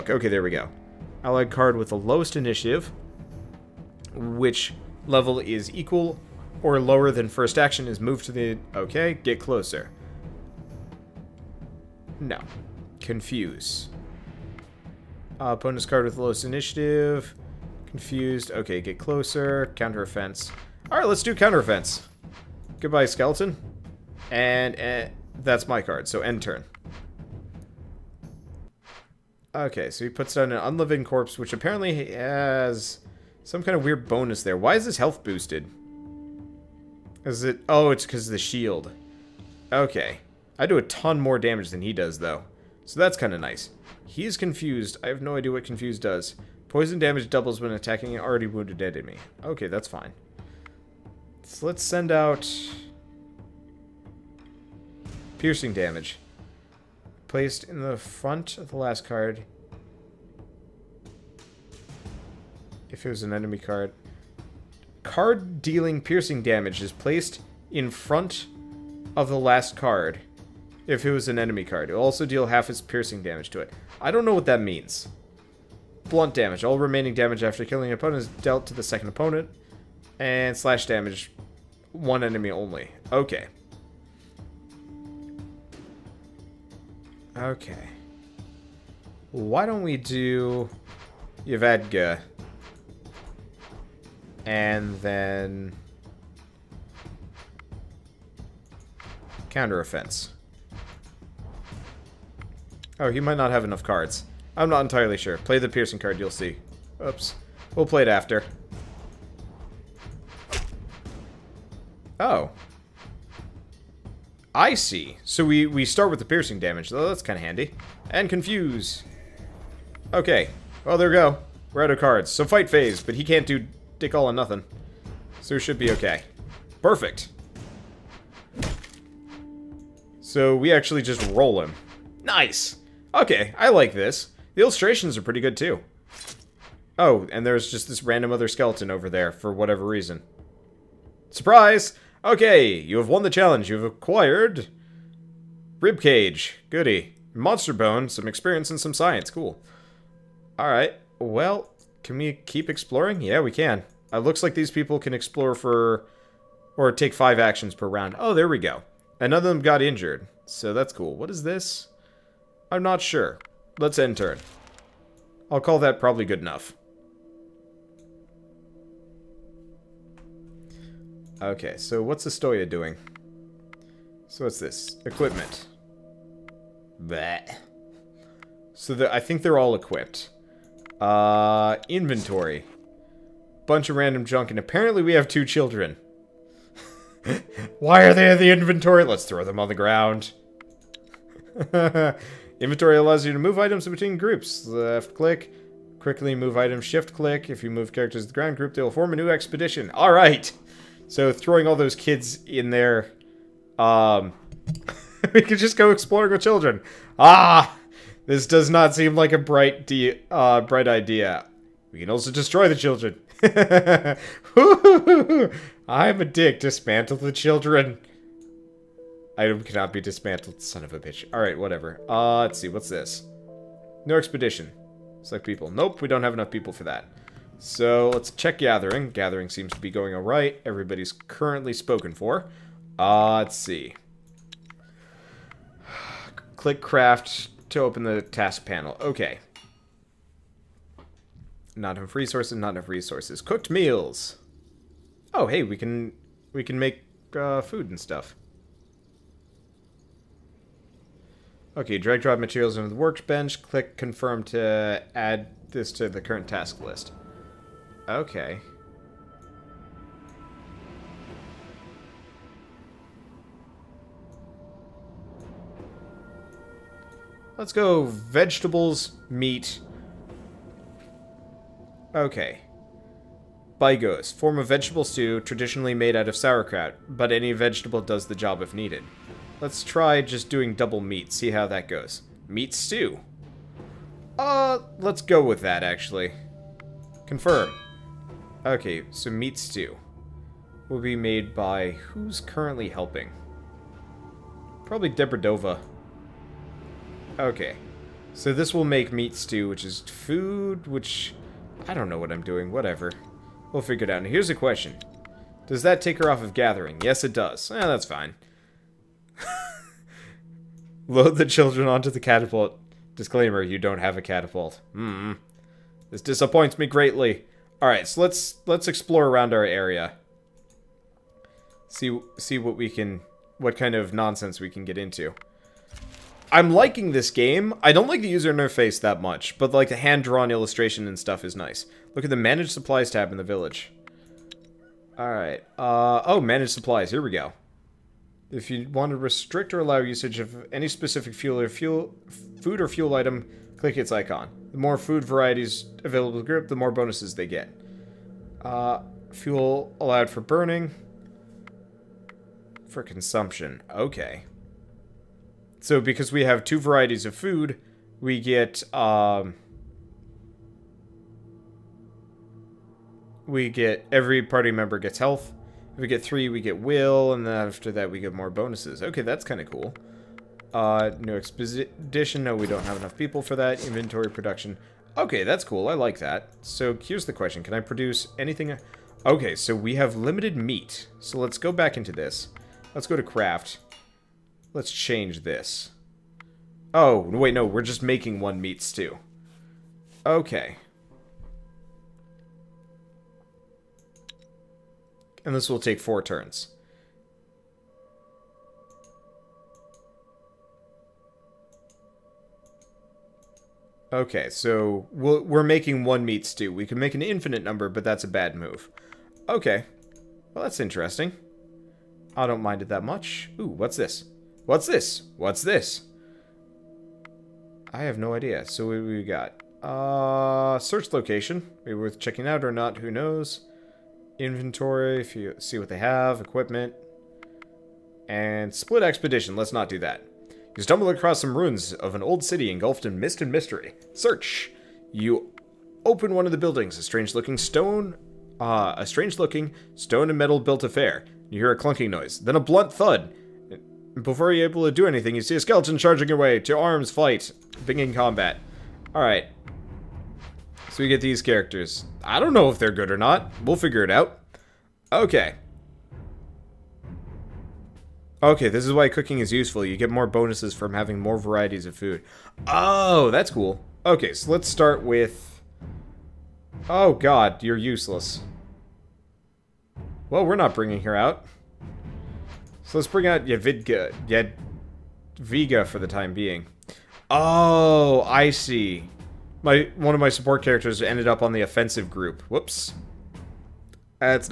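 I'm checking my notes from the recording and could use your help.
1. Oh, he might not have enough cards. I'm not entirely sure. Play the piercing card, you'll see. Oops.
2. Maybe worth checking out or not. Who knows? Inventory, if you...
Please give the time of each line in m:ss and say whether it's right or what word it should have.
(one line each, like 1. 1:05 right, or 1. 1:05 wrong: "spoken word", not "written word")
1. 1:42 right
2. 7:01 right.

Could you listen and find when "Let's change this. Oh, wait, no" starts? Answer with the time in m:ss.
6:24.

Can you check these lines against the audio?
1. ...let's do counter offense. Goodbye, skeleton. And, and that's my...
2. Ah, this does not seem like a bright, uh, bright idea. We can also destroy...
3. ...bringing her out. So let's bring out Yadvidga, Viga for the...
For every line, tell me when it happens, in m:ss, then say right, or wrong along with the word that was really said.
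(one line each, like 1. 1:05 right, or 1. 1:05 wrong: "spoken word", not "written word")
1. 0:21 right
2. 3:27 right
3. 7:50 right.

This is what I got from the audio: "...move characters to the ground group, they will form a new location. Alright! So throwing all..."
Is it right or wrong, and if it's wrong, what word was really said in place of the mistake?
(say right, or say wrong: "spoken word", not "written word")
wrong: "expedition", not "location".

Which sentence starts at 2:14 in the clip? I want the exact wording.
The illustrations are pretty good, too.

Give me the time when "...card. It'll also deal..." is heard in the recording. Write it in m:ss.
1:11.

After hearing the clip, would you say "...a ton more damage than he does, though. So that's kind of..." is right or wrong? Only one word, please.
right.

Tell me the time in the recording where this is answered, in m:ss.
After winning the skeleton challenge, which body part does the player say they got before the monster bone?
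2:25.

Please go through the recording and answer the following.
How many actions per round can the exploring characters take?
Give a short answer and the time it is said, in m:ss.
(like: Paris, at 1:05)
5, at 2:37.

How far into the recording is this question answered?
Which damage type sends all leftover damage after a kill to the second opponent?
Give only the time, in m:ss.
1:16.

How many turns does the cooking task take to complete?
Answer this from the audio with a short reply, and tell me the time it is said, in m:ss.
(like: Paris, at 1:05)
4, at 6:35.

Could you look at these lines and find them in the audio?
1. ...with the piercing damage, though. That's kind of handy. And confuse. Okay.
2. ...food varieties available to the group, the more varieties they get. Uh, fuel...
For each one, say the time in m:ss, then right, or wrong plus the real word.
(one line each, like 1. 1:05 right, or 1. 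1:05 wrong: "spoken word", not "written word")
1. 1:56 right
2. 5:44 wrong: "bonuses", not "varieties".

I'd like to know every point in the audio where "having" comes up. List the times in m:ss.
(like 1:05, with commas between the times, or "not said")
7:40.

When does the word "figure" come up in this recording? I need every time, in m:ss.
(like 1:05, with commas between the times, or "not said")
5:03, 7:33.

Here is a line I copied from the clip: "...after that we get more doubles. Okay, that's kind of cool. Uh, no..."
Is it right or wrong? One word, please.
wrong.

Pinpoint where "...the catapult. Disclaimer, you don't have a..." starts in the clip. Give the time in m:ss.
5:12.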